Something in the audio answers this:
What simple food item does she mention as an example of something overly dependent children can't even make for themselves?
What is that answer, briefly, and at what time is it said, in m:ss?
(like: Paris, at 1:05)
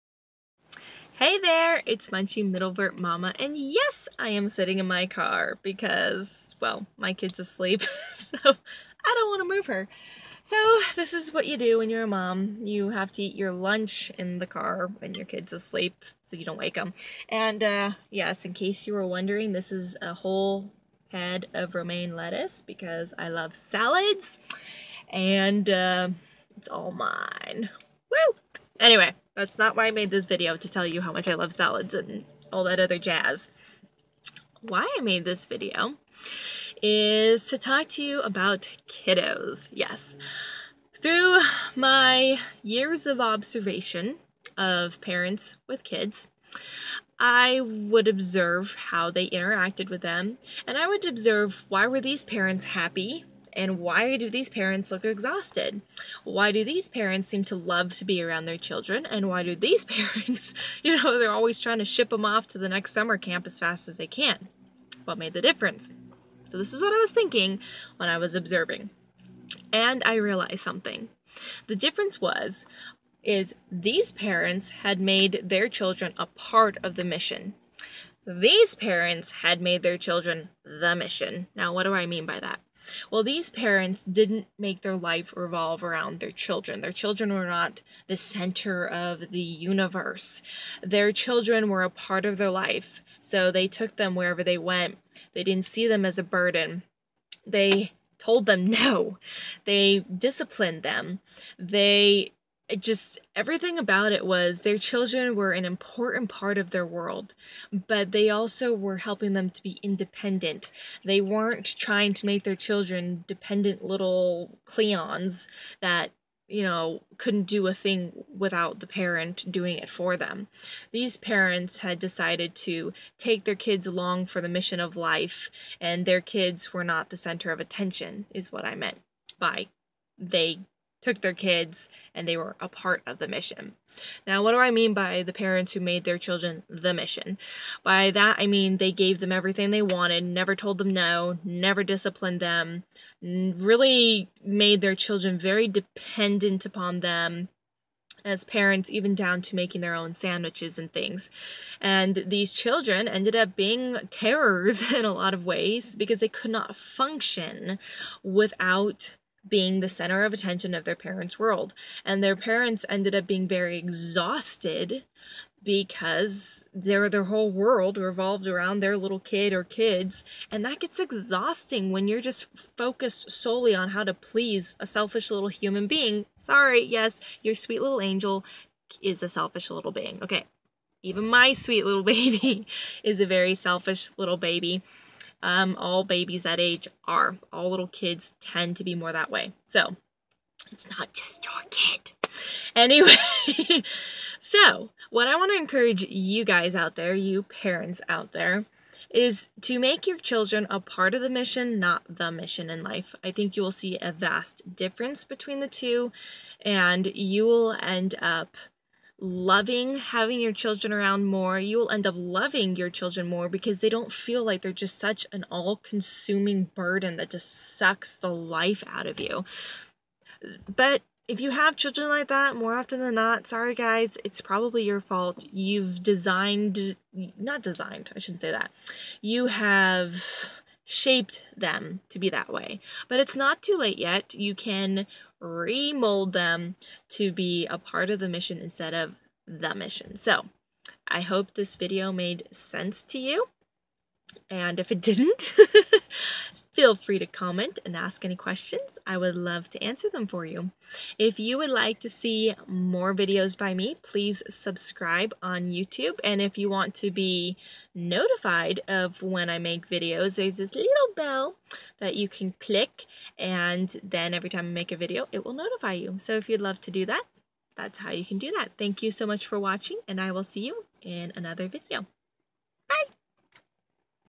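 sandwiches, at 2:30.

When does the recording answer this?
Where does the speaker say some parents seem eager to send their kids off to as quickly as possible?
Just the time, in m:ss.
1:02.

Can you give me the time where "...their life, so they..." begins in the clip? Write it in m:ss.
1:32.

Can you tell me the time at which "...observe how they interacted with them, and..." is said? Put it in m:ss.
0:48.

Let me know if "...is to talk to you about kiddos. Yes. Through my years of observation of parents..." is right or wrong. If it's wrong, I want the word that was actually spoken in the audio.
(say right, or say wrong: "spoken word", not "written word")
right.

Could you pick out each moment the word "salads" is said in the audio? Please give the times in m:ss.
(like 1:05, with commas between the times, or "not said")
0:23, 0:31.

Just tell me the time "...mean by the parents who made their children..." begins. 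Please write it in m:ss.
2:14.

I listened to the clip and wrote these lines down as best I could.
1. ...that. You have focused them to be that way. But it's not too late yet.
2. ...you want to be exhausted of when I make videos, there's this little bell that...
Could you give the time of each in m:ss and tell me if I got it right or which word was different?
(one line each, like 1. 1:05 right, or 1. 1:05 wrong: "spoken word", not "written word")
1. 3:48 wrong: "shaped", not "focused"
2. 4:16 wrong: "notified", not "exhausted".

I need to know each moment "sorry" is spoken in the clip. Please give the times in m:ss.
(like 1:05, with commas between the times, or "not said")
2:56, 3:43.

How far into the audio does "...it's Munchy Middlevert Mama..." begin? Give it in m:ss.
0:01.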